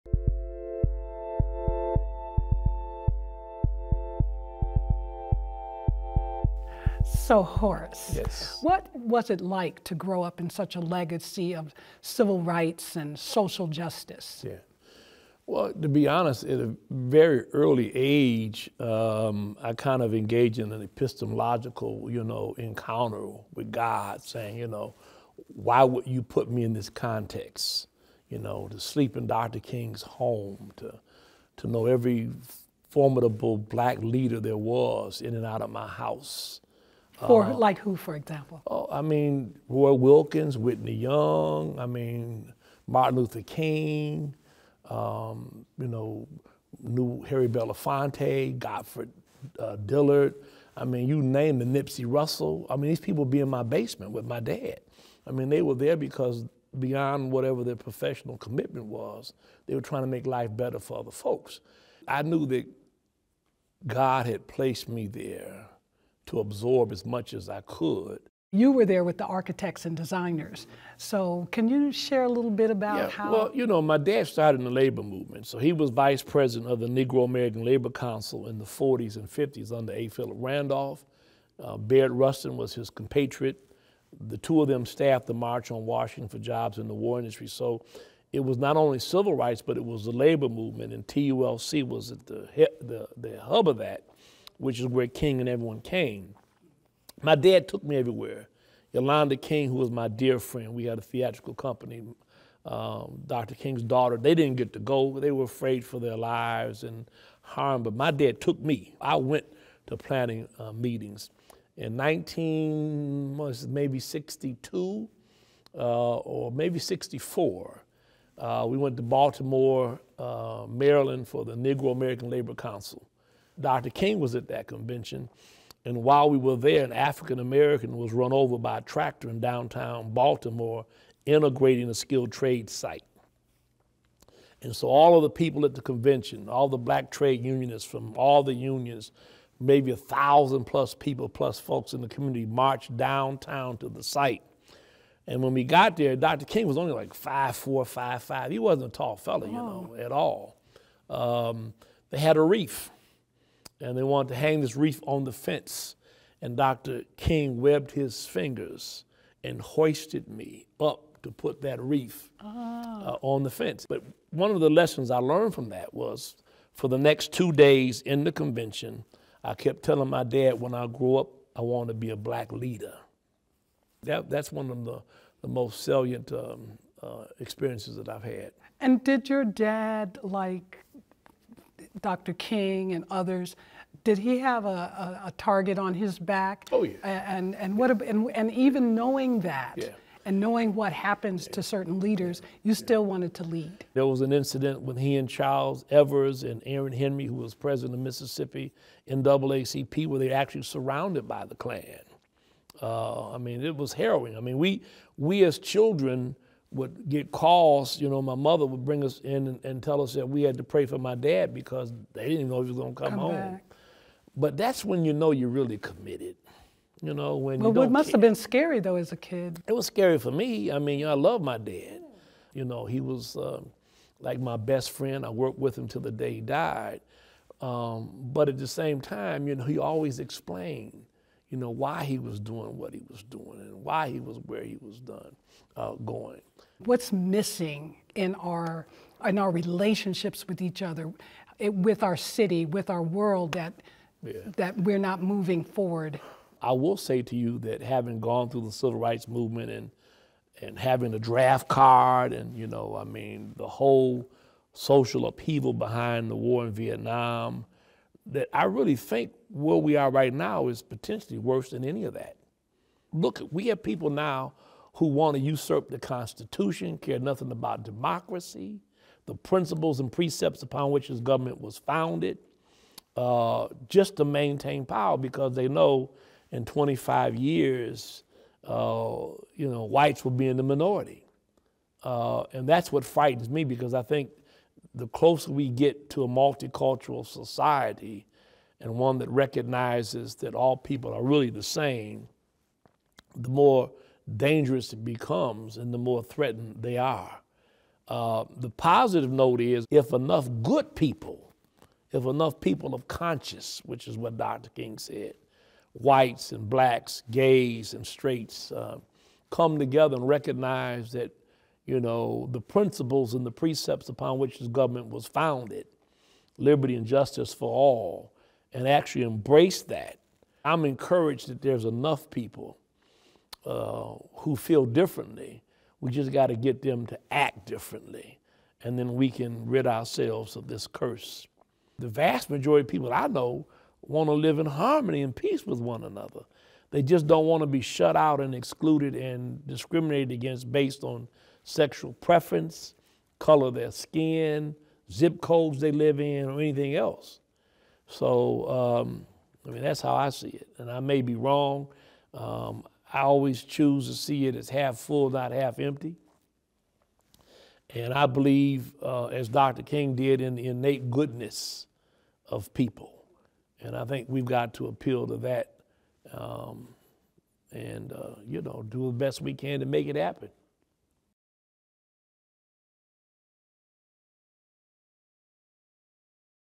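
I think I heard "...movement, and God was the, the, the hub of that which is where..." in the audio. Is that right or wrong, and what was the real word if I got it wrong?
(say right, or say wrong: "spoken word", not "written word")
wrong: "TULC", not "God".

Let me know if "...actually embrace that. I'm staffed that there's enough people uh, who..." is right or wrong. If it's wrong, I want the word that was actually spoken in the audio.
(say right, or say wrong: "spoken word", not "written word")
wrong: "encouraged", not "staffed".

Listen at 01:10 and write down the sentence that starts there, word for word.
So, can you share a little bit about yeah, how?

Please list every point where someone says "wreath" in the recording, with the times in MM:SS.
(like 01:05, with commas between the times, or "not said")
02:34, 02:41.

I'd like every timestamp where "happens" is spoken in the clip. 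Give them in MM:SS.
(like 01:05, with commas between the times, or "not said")
03:10, 06:10.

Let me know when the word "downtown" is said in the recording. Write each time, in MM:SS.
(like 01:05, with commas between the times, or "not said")
02:09, 02:22.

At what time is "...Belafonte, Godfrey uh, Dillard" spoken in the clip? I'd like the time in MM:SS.
00:47.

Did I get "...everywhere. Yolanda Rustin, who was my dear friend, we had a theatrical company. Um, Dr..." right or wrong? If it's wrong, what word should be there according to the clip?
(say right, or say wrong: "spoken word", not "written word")
wrong: "King", not "Rustin".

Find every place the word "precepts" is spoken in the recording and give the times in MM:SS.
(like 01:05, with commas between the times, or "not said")
04:30, 05:13.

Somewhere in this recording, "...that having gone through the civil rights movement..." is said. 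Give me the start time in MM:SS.
04:07.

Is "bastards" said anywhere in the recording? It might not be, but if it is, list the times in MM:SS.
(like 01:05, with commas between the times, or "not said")
not said.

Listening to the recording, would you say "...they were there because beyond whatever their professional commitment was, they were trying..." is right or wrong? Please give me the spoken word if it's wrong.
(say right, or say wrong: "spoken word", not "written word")
right.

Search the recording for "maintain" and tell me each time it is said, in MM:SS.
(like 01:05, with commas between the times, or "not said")
04:34.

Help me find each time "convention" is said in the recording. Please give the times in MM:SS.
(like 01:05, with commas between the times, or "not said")
02:04, 02:15, 02:48.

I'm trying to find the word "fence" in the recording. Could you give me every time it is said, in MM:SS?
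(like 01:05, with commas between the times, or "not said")
02:35, 02:43.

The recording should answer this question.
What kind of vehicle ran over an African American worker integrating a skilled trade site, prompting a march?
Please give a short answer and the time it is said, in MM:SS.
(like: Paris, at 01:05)
Tractor, at 02:08.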